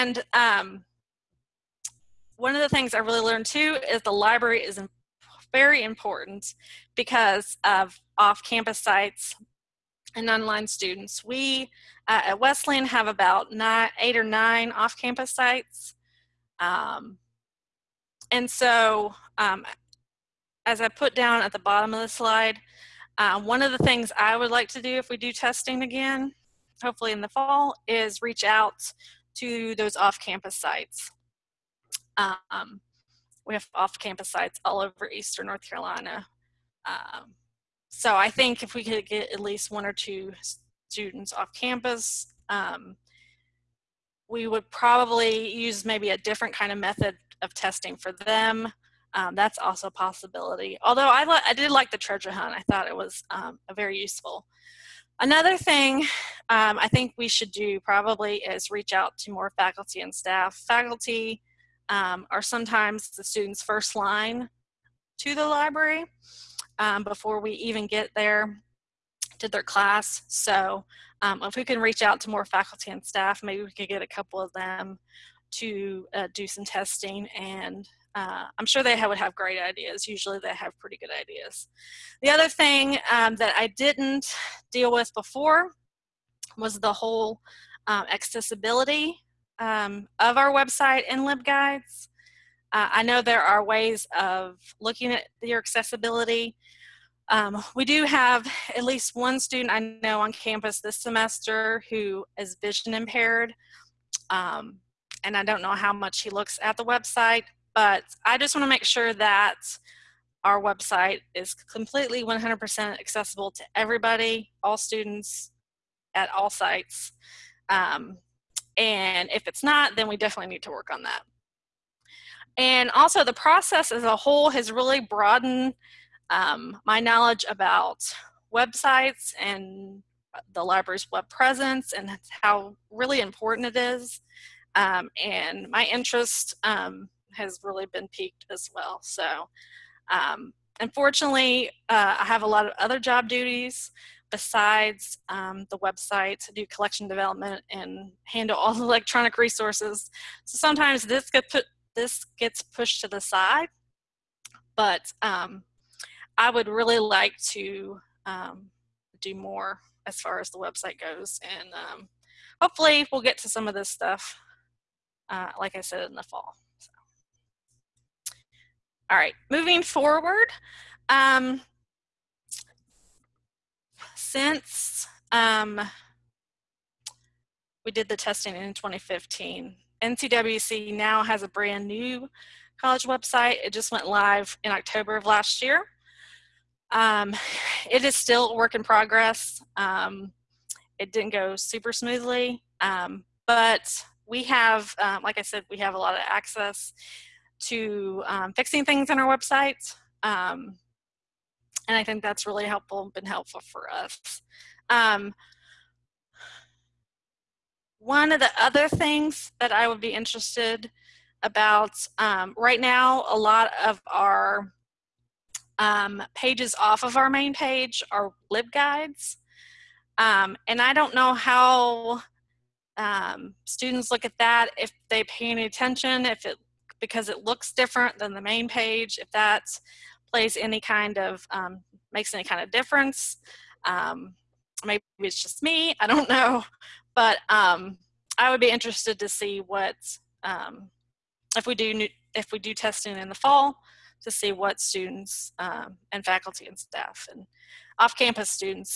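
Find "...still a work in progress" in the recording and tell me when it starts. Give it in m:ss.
3:08.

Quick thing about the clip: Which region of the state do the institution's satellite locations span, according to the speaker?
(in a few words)
Eastern North Carolina.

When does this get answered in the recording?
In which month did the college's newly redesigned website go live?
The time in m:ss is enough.
3:04.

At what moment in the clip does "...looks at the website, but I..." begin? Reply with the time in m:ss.
1:46.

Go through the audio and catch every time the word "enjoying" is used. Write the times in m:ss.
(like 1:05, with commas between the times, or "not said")
not said.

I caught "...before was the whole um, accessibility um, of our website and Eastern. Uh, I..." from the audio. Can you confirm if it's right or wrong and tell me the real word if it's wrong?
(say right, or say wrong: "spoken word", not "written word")
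wrong: "LibGuides", not "Eastern".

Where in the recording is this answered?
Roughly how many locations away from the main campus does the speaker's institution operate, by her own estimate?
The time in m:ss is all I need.
0:14.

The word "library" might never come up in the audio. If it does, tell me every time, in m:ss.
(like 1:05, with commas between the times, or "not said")
0:04, 1:05, 2:10.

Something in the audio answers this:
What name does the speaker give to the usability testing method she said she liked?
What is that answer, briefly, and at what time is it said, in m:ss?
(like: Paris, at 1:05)
treasure hunt, at 0:51.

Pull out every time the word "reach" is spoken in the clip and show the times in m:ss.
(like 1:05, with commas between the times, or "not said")
0:28, 0:58, 1:11.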